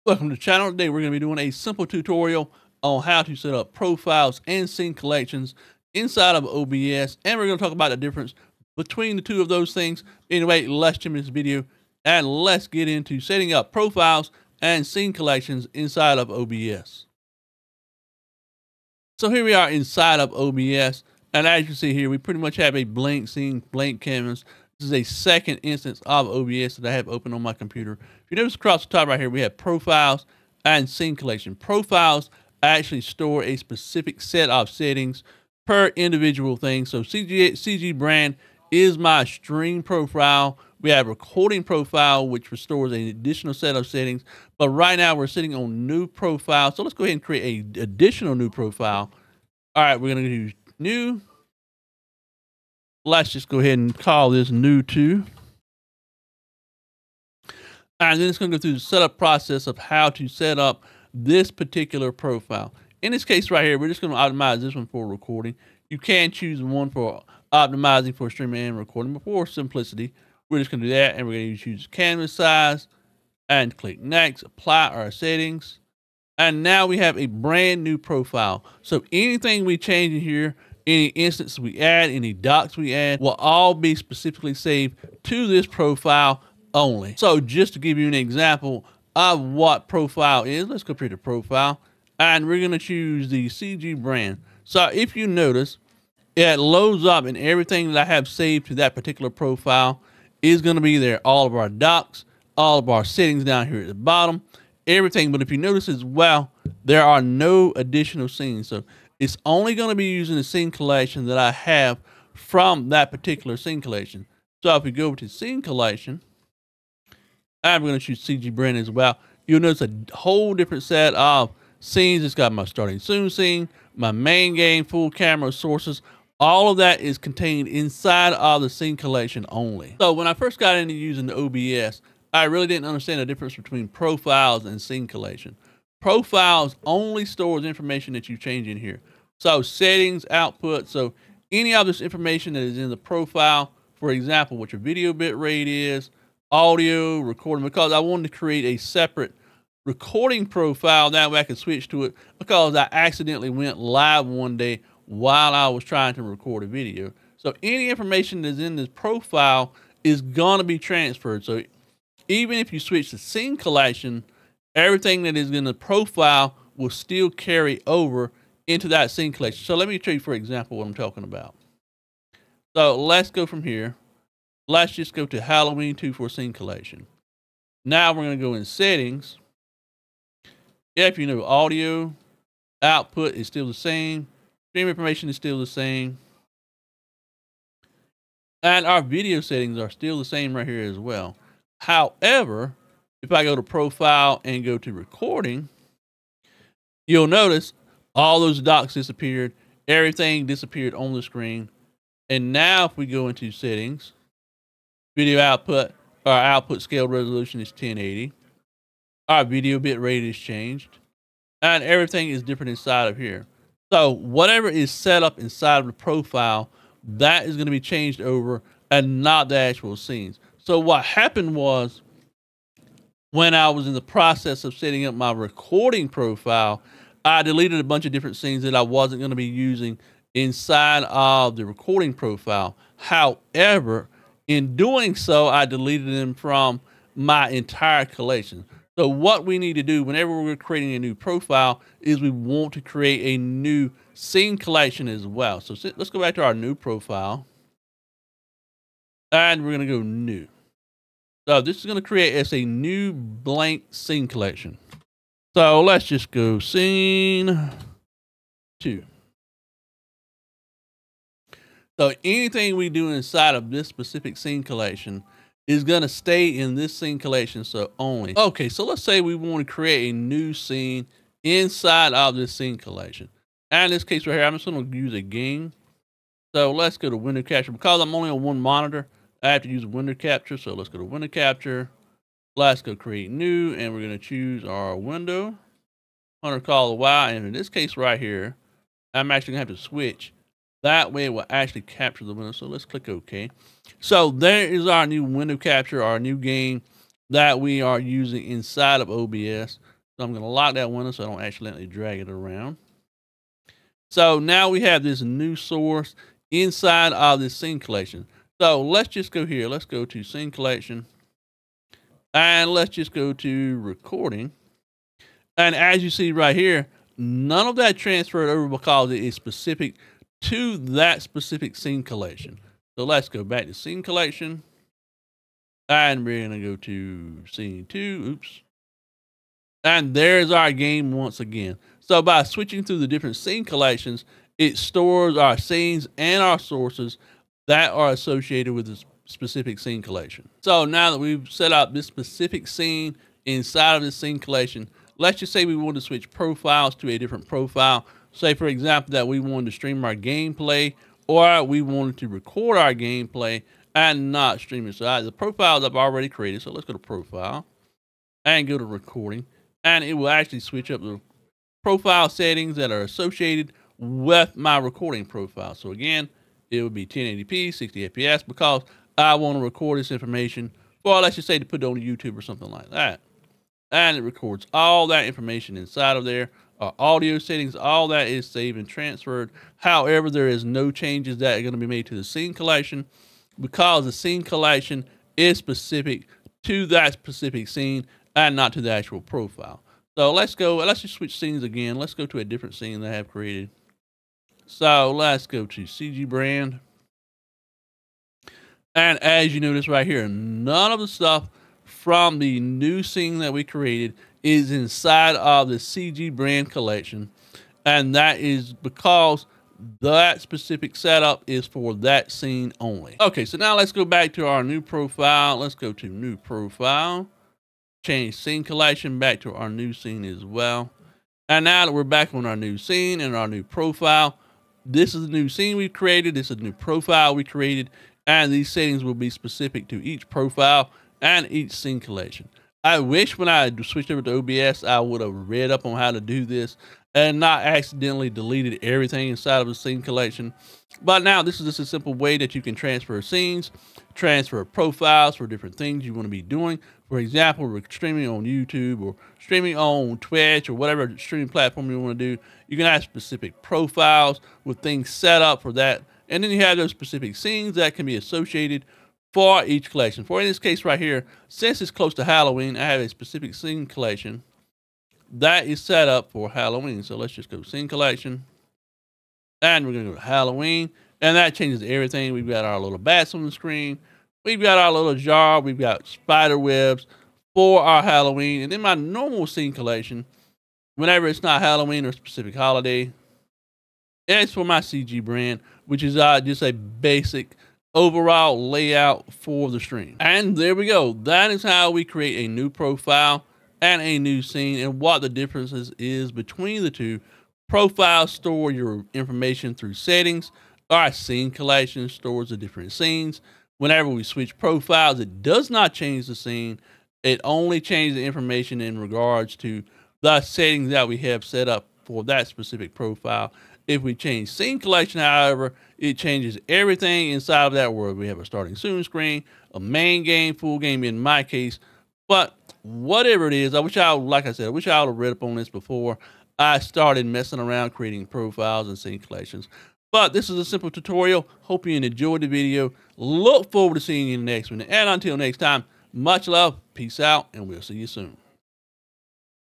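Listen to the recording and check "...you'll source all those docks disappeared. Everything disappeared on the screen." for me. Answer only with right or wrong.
wrong.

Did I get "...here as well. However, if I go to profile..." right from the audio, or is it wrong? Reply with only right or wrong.
right.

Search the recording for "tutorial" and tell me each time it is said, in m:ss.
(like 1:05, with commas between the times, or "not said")
0:01, 8:50.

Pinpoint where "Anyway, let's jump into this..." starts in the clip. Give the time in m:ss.
0:10.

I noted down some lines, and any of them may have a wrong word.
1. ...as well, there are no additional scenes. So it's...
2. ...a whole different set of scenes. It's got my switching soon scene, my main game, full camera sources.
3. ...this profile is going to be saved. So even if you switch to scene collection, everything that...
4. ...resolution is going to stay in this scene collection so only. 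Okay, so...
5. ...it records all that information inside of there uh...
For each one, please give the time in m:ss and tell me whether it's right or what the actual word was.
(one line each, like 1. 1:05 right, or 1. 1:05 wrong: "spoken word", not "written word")
1. 1:45 right
2. 1:59 wrong: "starting", not "switching"
3. 2:38 wrong: "transferred", not "saved"
4. 4:24 wrong: "collection", not "resolution"
5. 6:14 right.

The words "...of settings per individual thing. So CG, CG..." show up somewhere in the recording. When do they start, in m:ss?
0:34.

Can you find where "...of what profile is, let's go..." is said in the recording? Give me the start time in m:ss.
1:29.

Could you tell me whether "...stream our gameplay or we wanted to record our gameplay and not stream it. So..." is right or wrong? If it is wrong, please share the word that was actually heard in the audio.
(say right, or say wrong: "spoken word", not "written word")
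right.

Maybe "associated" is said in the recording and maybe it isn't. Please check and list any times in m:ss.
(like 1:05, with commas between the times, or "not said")
5:38, 6:03, 7:38.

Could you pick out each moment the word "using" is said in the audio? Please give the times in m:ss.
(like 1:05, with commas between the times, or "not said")
1:50, 2:10, 3:49, 4:57.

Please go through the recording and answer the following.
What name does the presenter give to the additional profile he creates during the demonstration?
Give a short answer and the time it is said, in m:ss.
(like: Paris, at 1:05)
new two, at 0:54.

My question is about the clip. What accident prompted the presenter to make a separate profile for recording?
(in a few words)
Accidentally went live.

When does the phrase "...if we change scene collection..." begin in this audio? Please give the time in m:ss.
8:33.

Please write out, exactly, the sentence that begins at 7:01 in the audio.
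And now that we're back on our new scene and our new profile, this is the new scene we've created.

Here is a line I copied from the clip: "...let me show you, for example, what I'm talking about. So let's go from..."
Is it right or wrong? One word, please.
right.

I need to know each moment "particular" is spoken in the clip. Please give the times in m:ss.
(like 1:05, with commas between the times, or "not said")
1:01, 1:38, 1:53.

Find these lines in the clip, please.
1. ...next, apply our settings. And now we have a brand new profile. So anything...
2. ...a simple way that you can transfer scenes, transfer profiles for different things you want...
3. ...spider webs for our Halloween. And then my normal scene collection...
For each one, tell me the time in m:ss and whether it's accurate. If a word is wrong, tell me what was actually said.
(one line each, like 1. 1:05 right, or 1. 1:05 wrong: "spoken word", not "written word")
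1. 1:14 right
2. 7:21 right
3. 7:56 right.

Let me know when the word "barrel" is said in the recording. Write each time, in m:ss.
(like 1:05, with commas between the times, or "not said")
not said.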